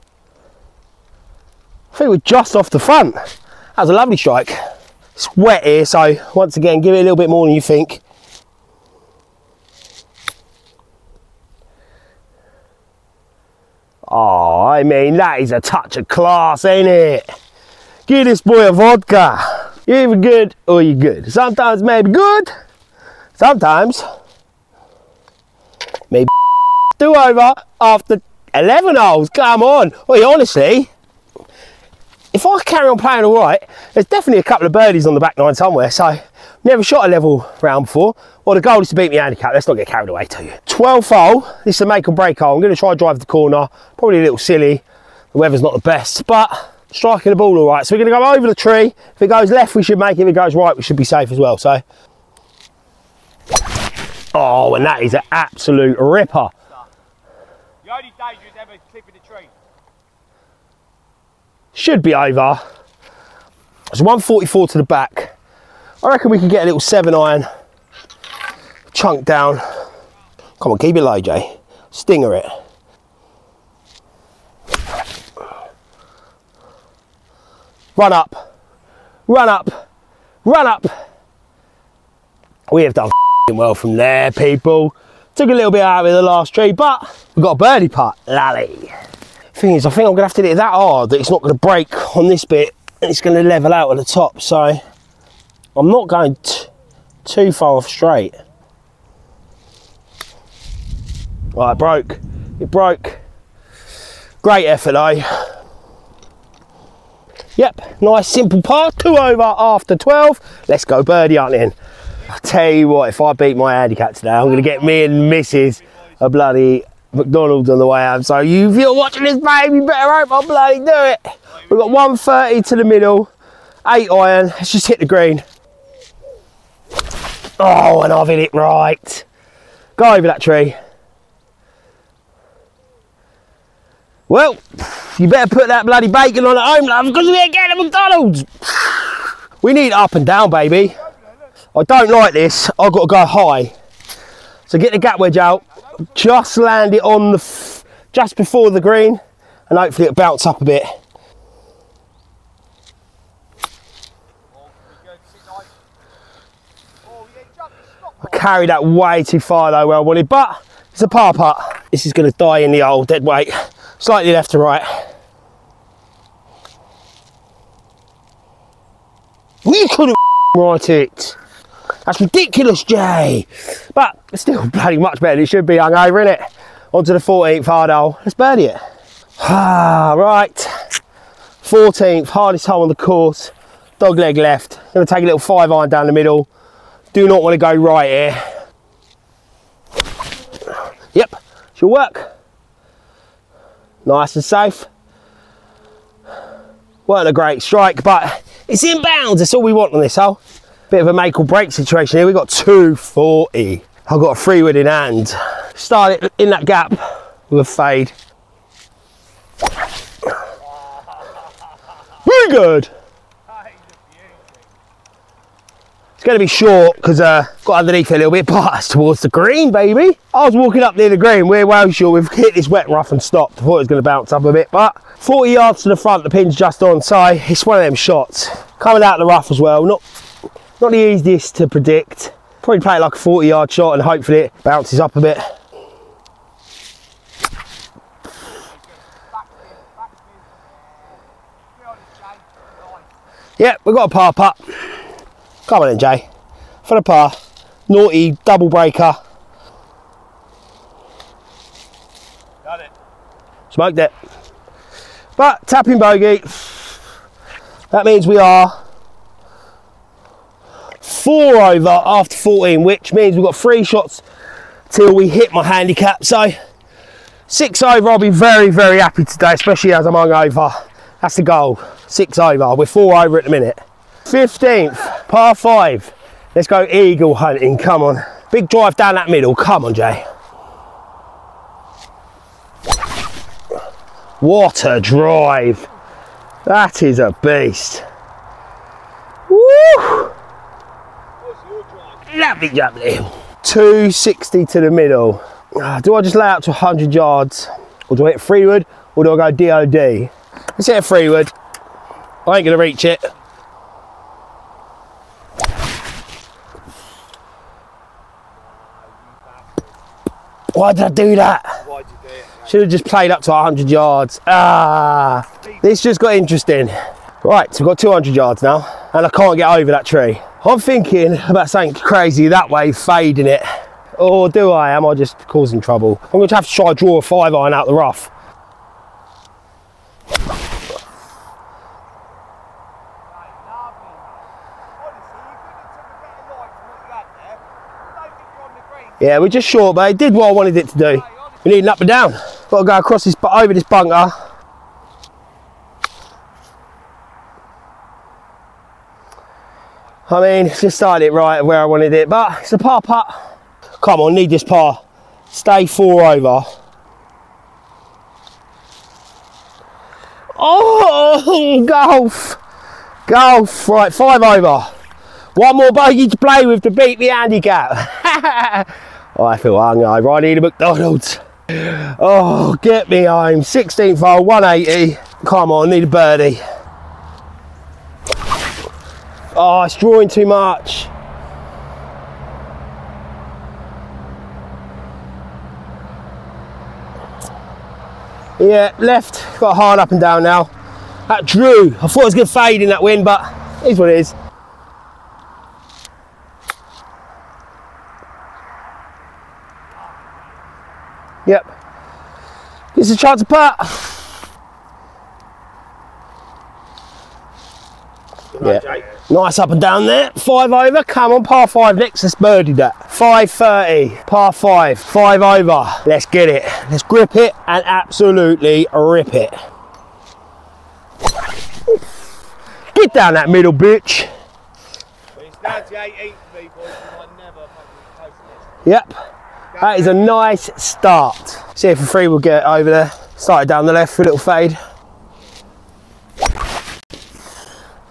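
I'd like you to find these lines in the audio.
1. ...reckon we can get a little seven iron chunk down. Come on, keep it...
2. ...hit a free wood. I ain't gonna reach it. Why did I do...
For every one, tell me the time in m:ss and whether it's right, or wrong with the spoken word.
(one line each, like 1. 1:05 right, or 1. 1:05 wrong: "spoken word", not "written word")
1. 1:06 right
2. 5:00 right.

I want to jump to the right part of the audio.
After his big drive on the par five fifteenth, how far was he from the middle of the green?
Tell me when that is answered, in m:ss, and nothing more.
4:53.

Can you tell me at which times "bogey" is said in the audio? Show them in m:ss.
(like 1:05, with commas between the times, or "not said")
4:16, 6:05.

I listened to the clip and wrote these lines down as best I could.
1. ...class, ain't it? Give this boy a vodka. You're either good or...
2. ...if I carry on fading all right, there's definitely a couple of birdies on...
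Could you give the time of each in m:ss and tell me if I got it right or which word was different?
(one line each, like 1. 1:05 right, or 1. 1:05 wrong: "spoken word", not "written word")
1. 0:16 right
2. 0:32 wrong: "playing", not "fading".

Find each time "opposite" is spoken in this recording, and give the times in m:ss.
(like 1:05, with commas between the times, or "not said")
not said.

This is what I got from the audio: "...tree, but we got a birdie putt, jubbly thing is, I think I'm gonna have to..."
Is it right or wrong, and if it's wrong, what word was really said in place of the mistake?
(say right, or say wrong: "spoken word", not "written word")
wrong: "lally", not "jubbly".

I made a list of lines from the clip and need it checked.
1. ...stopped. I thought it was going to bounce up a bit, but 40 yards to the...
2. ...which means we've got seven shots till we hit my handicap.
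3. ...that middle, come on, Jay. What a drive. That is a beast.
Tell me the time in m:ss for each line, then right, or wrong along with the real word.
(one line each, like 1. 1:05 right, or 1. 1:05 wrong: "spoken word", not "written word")
1. 3:43 right
2. 4:22 wrong: "three", not "seven"
3. 4:39 right.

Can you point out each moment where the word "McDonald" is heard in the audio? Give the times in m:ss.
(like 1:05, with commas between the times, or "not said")
1:57, 2:17, 6:10.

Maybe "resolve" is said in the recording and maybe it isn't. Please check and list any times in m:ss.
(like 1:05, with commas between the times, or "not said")
not said.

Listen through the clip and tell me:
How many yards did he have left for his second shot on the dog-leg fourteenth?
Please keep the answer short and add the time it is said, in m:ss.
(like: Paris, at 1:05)
240, at 3:22.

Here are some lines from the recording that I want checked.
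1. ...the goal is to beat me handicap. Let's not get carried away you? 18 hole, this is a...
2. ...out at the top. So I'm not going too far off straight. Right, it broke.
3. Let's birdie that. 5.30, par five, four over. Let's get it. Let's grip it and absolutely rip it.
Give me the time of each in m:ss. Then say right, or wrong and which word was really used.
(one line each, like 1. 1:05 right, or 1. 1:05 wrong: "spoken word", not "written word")
1. 0:38 wrong: "12", not "18"
2. 1:33 right
3. 6:52 wrong: "five", not "four".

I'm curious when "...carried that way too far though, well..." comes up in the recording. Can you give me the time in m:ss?
2:38.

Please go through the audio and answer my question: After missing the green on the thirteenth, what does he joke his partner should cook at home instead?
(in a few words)
bacon.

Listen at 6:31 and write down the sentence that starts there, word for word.
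That drew, I thought it was going to fade in that wind, but it is what it is.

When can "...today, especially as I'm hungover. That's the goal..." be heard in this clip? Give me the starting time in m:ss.
4:29.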